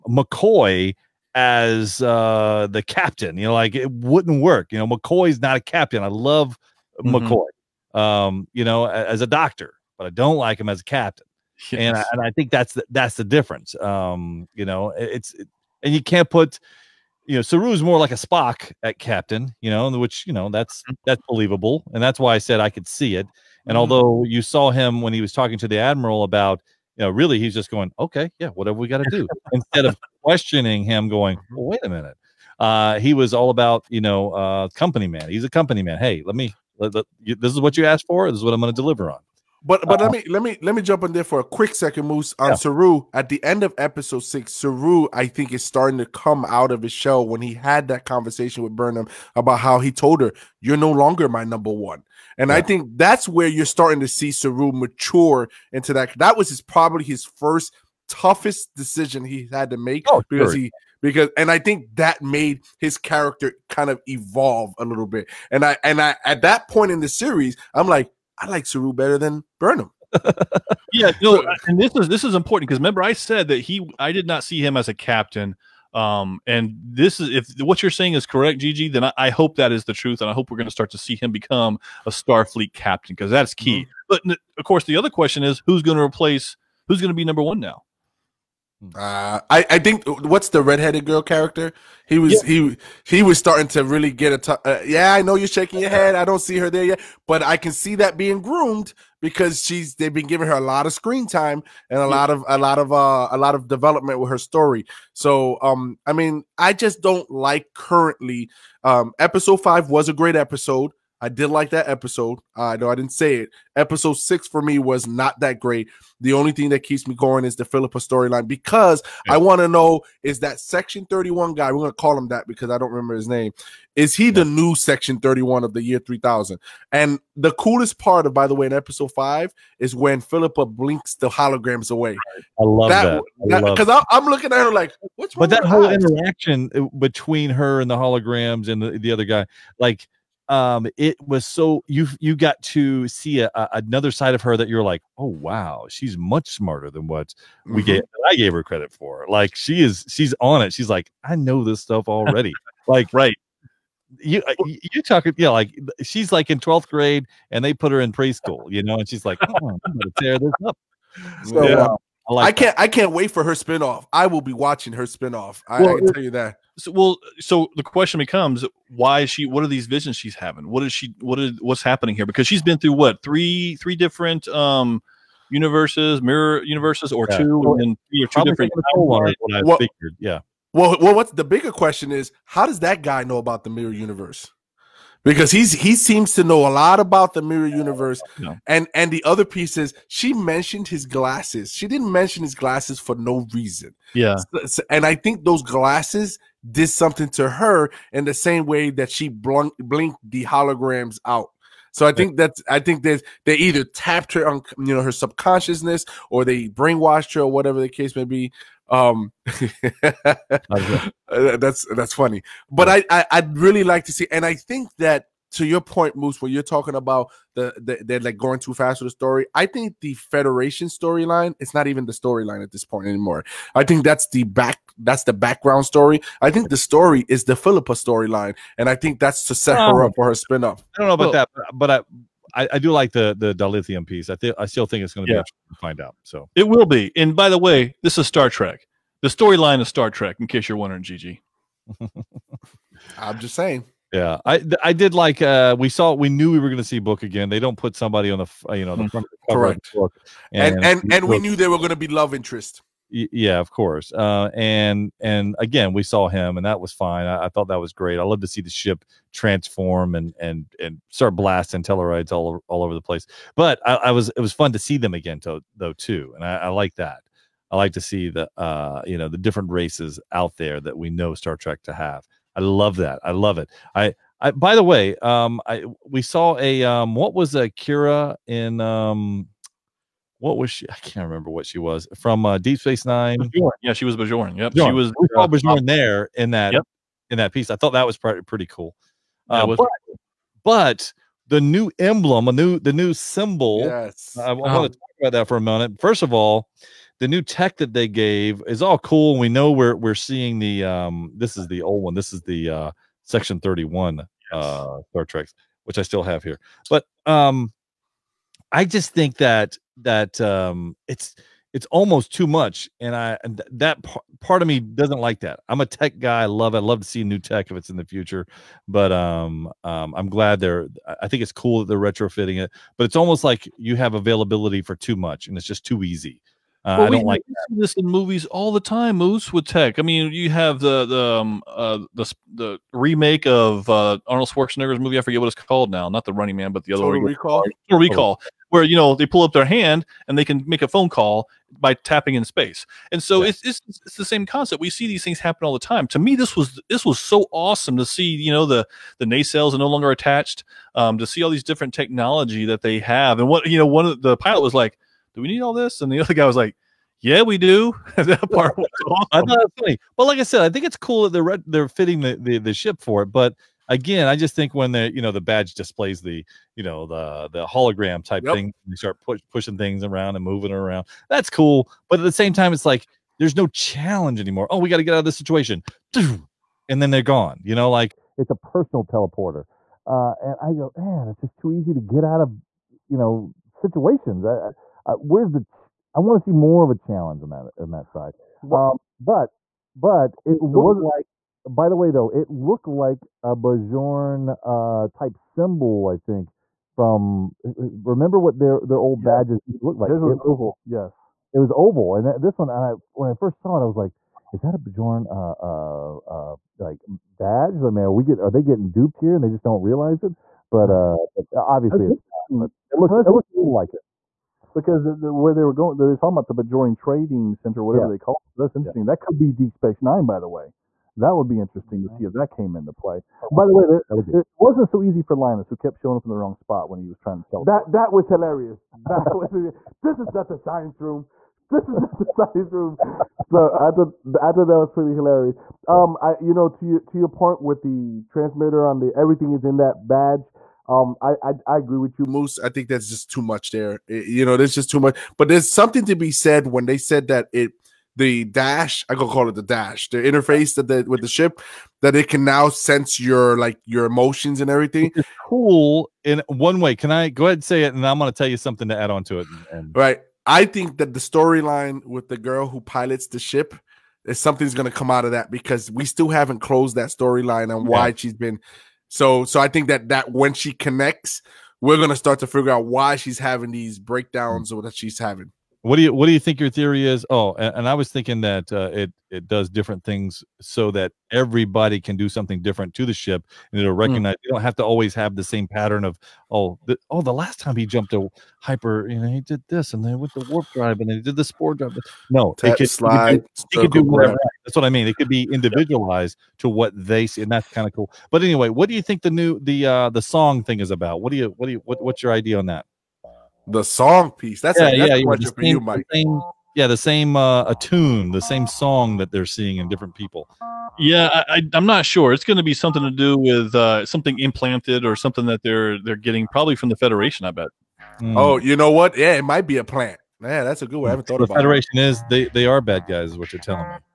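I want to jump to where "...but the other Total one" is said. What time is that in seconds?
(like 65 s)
336 s.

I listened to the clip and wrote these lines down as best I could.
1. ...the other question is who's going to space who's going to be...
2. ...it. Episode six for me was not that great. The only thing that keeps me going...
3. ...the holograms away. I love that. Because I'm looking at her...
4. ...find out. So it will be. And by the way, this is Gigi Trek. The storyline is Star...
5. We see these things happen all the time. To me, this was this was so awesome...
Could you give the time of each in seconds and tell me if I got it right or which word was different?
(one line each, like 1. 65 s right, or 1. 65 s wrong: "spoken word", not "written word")
1. 84 s wrong: "replace", not "space"
2. 113 s right
3. 131 s right
4. 235 s wrong: "Star", not "Gigi"
5. 344 s right.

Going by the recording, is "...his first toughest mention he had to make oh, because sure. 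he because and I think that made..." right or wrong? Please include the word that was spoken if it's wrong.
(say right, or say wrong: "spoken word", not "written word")
wrong: "decision", not "mention".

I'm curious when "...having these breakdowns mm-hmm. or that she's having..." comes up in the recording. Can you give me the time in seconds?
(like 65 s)
473 s.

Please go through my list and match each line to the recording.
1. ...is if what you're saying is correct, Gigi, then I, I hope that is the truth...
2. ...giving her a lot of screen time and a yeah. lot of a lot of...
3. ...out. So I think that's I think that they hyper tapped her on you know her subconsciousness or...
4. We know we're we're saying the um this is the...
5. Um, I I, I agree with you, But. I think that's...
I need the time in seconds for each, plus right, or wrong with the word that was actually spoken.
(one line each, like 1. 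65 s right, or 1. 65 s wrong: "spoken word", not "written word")
1. 77 s right
2. 100 s right
3. 201 s wrong: "either", not "hyper"
4. 299 s wrong: "seeing", not "saying"
5. 440 s wrong: "Moose", not "But".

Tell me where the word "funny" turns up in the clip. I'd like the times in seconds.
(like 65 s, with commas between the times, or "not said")
212 s, 359 s.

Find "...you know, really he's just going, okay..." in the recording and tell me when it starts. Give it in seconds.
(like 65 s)
26 s.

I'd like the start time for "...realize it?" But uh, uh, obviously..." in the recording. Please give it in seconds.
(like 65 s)
409 s.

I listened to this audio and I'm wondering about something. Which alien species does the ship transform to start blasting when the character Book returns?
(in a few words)
Tellarites.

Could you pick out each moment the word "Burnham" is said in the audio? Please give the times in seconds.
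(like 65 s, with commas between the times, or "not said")
48 s, 69 s.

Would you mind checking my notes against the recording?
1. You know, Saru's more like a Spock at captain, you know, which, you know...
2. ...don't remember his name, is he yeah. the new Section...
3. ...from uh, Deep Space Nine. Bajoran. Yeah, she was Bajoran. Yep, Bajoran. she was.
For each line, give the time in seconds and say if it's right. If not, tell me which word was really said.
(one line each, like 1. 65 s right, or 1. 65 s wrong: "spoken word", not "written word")
1. 17 s right
2. 122 s right
3. 282 s right.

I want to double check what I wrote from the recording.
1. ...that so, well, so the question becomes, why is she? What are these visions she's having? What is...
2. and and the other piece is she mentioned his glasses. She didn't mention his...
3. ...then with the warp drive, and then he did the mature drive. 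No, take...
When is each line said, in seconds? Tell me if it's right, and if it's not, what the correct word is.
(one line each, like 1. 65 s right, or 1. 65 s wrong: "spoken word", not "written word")
1. 166 s right
2. 188 s right
3. 490 s wrong: "spore", not "mature".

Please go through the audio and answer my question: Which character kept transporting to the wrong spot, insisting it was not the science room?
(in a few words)
Linus.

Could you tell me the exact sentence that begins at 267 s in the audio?
I like to see the uh you know the different races out there that we know Star Trek to have.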